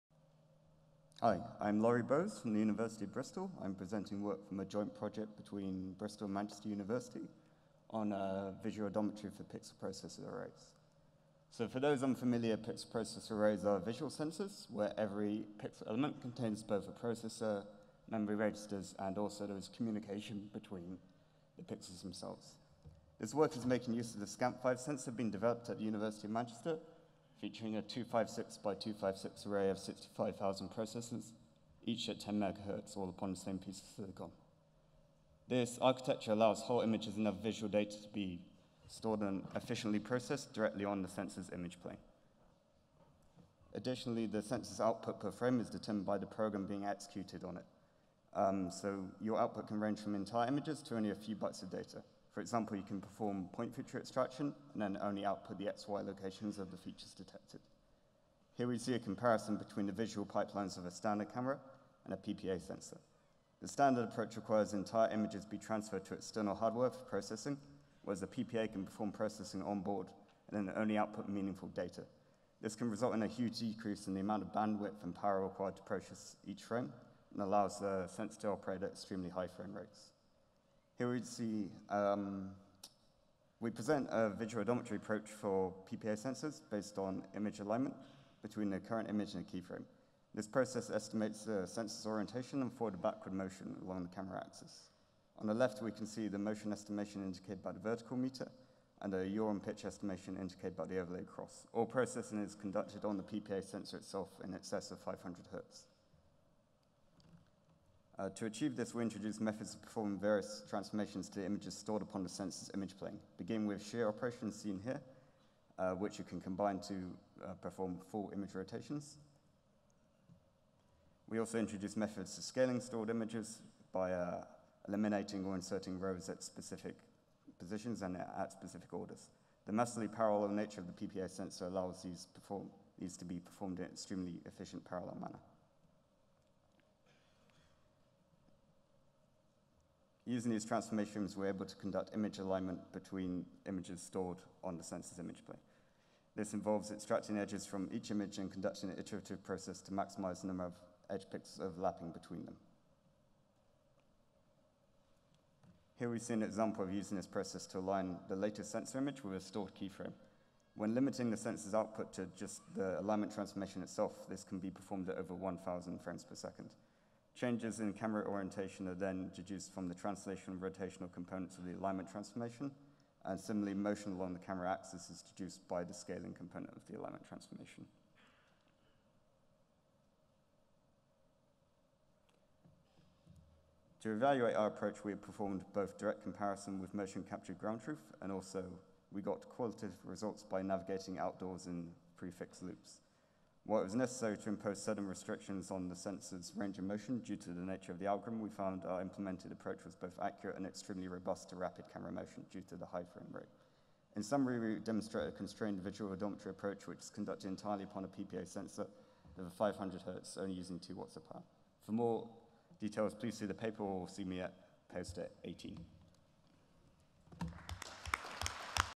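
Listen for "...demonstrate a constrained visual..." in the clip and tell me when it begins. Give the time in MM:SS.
03:24.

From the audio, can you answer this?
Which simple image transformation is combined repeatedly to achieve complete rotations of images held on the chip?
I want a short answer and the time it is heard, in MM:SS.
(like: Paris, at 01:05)
Shear operations, at 01:53.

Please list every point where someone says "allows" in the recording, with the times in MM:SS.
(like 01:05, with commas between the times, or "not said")
00:36, 01:17, 02:11.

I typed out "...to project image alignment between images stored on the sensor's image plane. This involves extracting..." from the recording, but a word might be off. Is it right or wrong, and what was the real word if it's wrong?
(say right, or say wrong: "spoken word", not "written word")
wrong: "conduct", not "project".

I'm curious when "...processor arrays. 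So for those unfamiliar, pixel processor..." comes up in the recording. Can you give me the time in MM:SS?
00:09.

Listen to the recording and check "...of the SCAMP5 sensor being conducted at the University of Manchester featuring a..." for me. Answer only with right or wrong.
wrong.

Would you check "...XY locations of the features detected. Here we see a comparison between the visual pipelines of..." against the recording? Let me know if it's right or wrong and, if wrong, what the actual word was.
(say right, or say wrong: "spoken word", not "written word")
right.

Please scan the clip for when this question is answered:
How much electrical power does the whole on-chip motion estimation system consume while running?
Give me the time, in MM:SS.
03:30.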